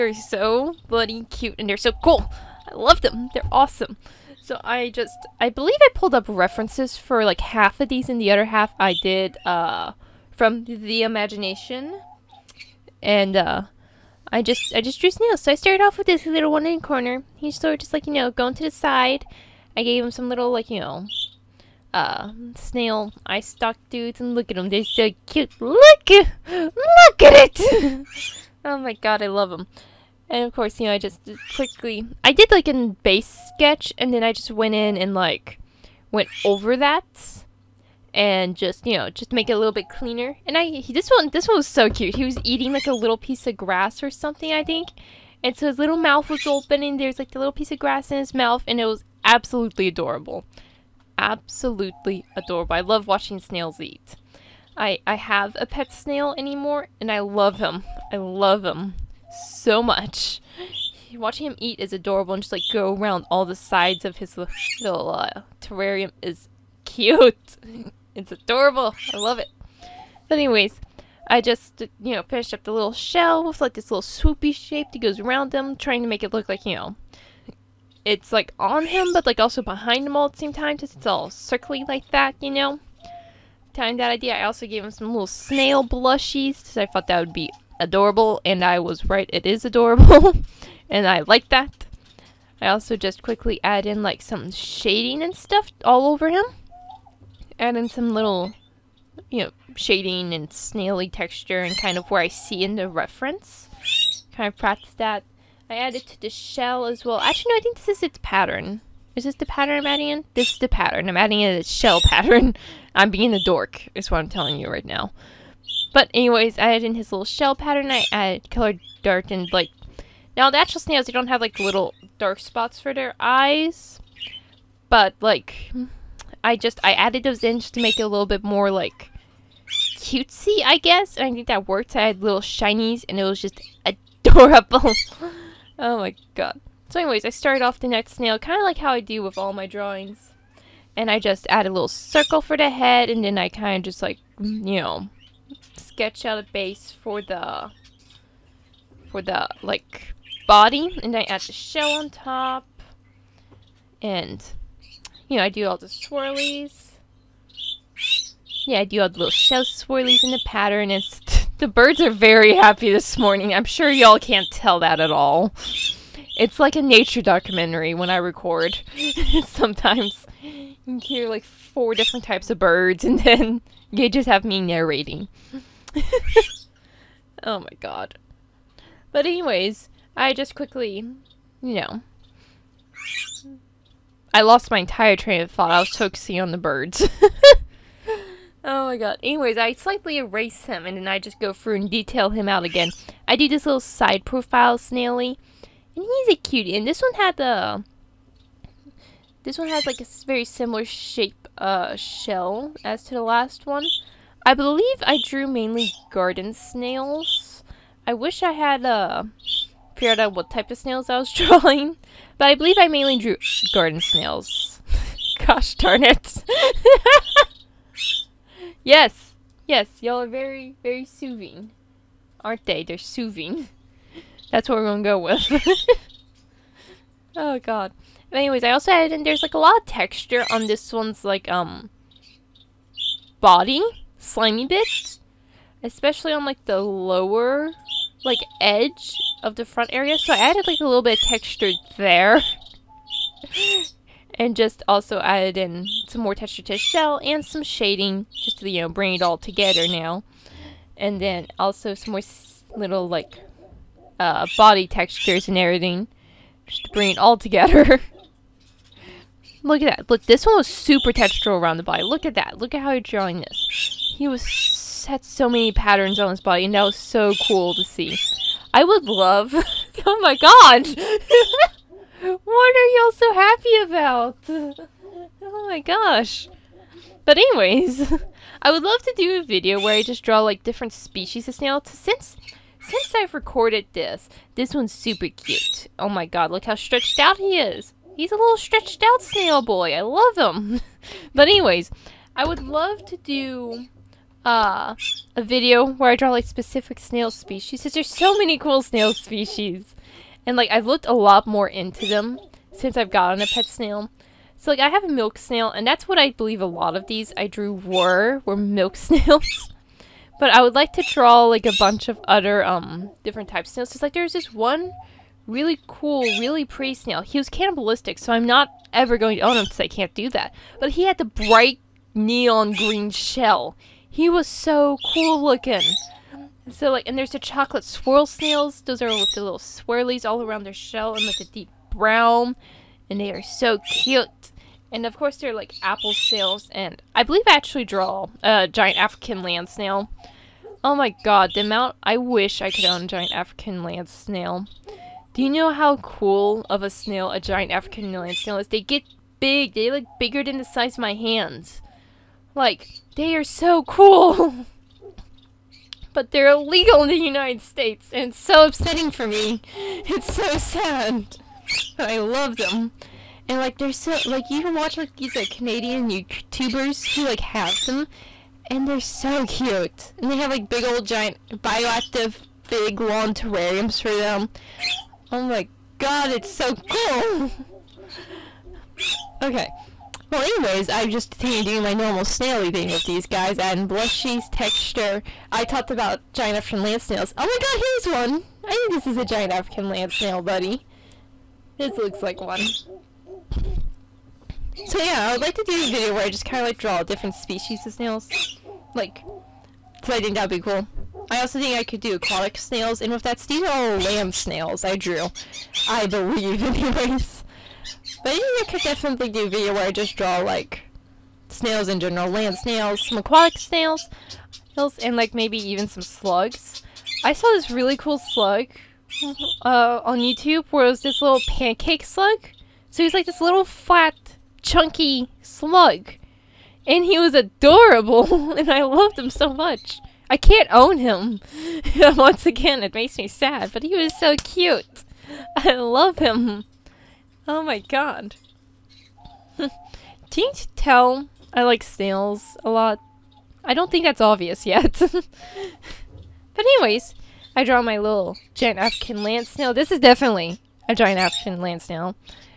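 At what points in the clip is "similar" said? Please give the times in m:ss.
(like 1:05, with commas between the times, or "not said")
3:20.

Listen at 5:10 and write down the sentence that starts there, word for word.
but I would like to draw like a bunch of other um different types of snails.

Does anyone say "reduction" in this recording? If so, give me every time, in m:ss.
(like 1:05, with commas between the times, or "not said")
not said.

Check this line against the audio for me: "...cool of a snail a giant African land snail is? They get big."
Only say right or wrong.
right.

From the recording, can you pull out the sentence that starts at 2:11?
I had little shinies and it was just adorable.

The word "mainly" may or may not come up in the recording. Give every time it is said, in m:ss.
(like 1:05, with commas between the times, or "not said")
3:25, 3:32.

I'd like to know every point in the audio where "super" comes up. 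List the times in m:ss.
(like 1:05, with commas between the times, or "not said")
4:20, 4:44.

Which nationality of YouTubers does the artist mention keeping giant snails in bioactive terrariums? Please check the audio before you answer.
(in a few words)
Canadian.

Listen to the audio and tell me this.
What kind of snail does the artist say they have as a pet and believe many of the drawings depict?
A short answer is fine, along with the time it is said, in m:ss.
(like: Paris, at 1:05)
milk snail, at 5:05.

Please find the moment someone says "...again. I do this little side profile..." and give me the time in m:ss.
3:12.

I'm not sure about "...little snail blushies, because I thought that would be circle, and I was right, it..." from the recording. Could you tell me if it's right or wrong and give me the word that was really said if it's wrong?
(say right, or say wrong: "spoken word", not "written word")
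wrong: "adorable", not "circle".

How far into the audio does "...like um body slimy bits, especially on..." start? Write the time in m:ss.
3:51.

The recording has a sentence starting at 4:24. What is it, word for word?
He was had so many patterns on his body, and that was so cool to see.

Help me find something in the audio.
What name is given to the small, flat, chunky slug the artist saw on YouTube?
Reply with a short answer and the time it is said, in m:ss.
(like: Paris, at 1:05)
pancake slug, at 7:01.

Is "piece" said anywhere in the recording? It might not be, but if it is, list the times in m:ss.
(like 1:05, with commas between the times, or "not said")
0:43, 0:47.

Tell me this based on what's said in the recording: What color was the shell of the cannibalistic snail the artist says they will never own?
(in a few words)
neon green.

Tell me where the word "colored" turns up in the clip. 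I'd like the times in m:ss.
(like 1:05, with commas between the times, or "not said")
1:58.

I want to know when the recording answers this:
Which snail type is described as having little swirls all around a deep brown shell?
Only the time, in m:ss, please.
5:27.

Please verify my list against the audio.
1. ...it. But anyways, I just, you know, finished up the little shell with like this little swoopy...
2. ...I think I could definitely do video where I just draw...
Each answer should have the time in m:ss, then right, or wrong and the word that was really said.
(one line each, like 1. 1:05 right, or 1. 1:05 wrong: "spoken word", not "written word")
1. 1:09 right
2. 6:48 right.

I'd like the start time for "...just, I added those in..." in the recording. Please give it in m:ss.
2:06.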